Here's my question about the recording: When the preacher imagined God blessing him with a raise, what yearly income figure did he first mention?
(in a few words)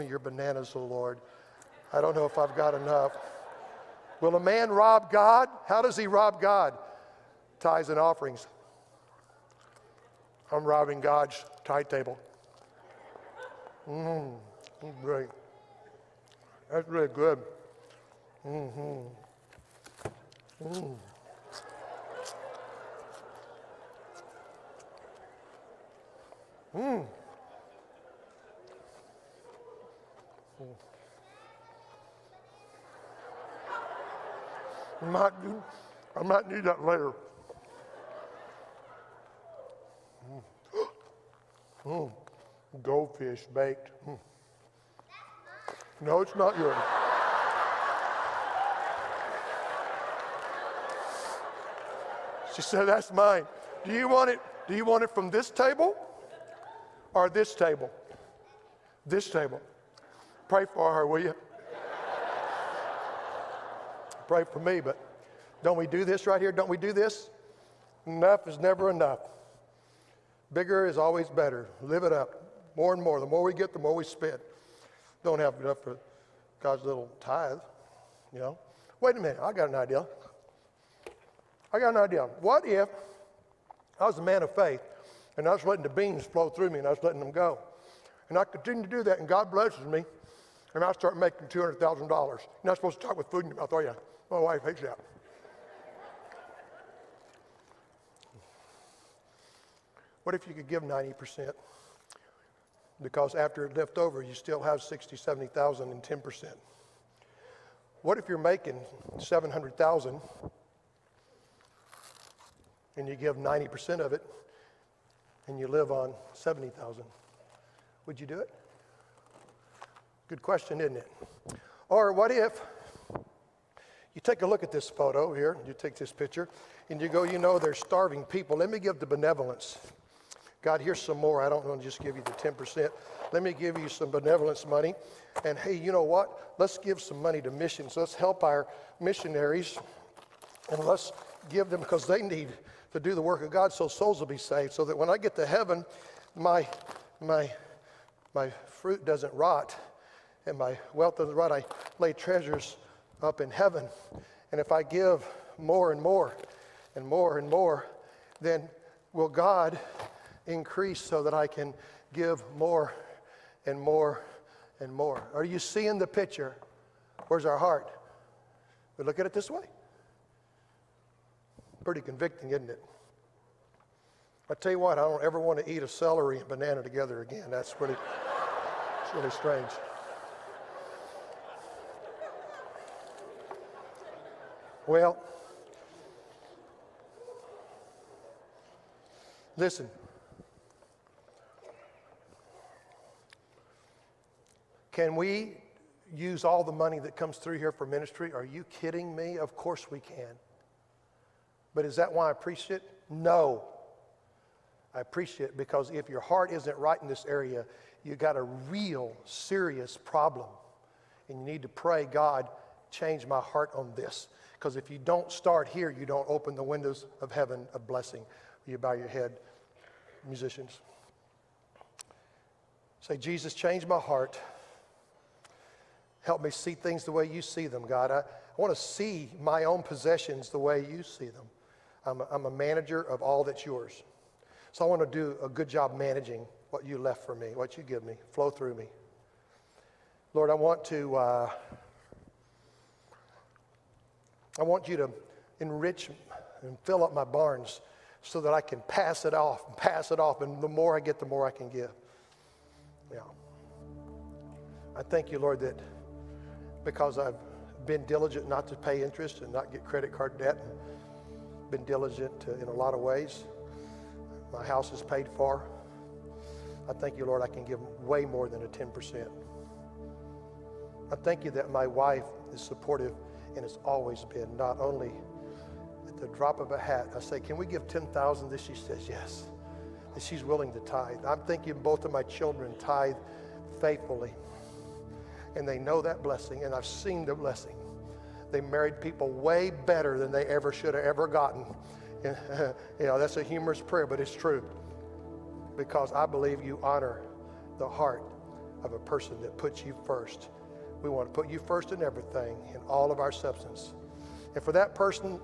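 $200,000.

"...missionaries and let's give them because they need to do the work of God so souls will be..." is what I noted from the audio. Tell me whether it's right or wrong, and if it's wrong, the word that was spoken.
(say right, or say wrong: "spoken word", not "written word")
right.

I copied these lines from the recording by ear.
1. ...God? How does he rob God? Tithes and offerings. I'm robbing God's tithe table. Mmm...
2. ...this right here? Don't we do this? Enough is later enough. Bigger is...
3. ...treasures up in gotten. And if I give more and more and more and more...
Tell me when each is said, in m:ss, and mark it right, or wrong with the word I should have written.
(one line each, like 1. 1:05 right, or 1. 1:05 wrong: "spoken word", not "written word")
1. 0:05 right
2. 1:06 wrong: "never", not "later"
3. 2:32 wrong: "heaven", not "gotten".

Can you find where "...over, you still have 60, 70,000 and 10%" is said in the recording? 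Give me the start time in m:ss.
1:43.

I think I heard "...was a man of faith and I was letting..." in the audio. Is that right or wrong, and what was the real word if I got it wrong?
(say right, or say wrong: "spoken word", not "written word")
right.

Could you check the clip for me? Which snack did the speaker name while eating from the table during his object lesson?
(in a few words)
Goldfish.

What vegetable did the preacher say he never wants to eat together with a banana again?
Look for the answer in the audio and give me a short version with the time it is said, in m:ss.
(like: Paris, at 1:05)
Celery, at 2:55.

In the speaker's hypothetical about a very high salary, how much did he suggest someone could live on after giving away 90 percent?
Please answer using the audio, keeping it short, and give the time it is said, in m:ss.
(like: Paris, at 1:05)
$70,000, at 1:55.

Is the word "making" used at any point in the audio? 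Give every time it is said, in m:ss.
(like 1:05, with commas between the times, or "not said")
1:31, 1:48.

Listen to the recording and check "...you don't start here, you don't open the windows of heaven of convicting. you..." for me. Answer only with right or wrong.
wrong.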